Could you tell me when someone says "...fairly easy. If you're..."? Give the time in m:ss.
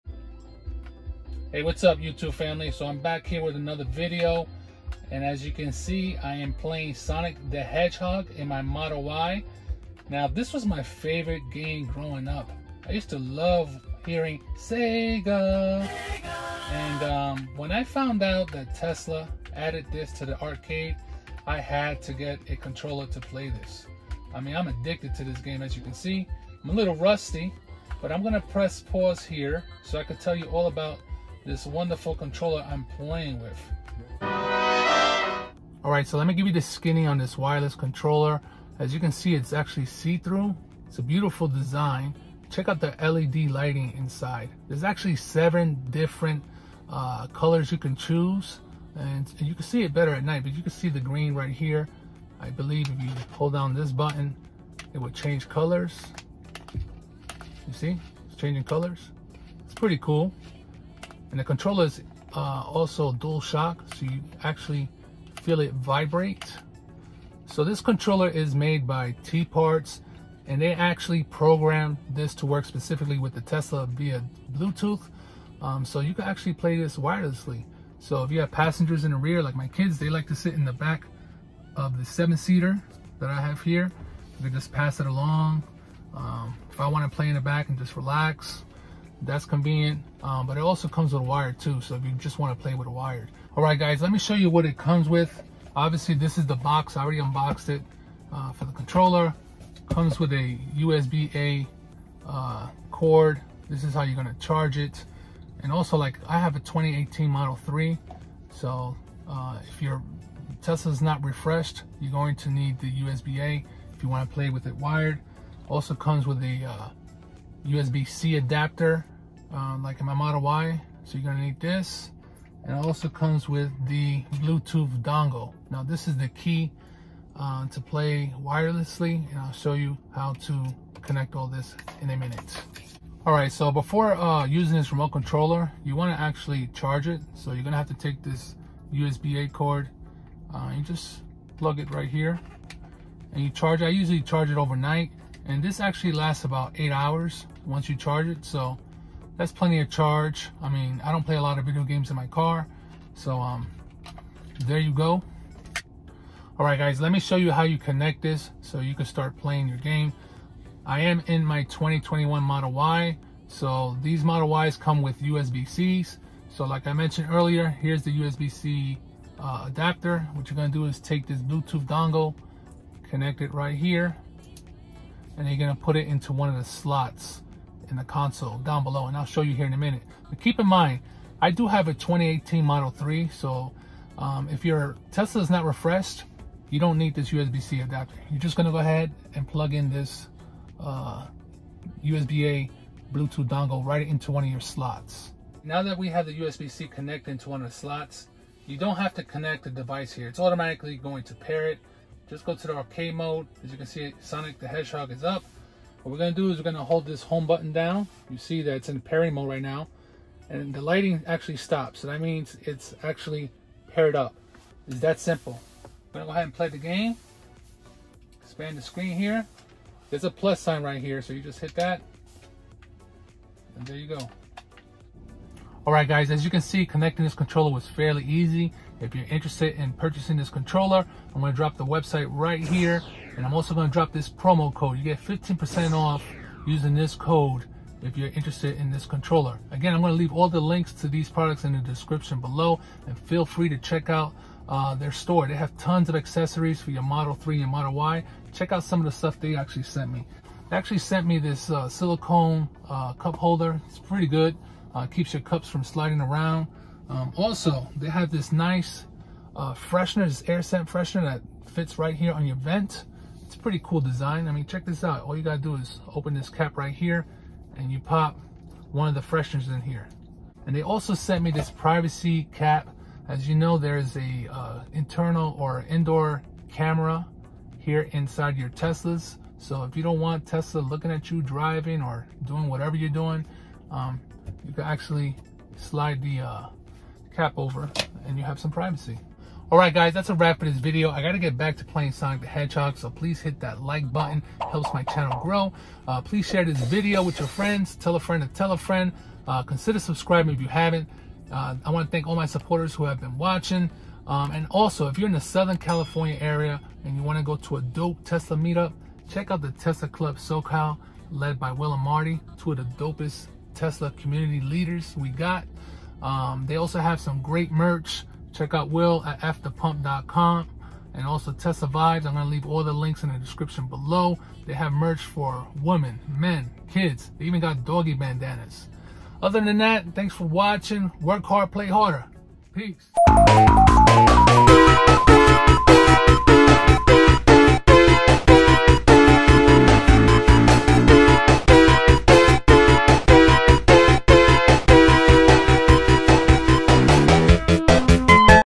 3:47.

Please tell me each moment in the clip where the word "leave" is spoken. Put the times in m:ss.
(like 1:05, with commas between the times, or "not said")
4:00, 5:22.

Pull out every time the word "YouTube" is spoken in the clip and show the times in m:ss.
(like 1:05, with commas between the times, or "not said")
0:01.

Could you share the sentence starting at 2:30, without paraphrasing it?
I mean, I don't play a lot of video games in my car.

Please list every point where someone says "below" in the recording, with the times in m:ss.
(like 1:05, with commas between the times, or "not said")
2:58, 4:02, 5:23.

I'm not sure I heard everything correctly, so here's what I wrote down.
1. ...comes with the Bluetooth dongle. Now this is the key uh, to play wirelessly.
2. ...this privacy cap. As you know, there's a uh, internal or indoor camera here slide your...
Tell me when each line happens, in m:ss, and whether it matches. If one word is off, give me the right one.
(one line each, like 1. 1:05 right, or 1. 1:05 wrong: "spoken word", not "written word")
1. 2:03 right
2. 4:31 wrong: "inside", not "slide".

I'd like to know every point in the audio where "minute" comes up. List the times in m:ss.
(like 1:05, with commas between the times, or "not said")
2:12, 2:59.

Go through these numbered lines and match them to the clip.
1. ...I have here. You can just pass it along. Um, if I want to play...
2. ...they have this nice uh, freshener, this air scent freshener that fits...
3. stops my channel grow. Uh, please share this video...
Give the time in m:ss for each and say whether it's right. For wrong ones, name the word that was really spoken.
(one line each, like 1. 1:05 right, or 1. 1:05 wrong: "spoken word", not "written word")
1. 1:23 right
2. 4:17 right
3. 4:54 wrong: "helps", not "stops".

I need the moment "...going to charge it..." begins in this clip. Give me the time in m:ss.
1:44.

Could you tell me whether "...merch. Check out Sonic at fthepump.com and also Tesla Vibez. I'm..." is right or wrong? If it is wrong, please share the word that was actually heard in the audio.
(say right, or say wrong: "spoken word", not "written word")
wrong: "Will", not "Sonic".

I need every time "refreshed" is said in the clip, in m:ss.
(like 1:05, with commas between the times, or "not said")
1:51, 3:05.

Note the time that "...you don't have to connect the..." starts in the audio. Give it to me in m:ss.
3:18.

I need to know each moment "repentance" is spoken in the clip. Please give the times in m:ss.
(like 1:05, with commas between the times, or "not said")
not said.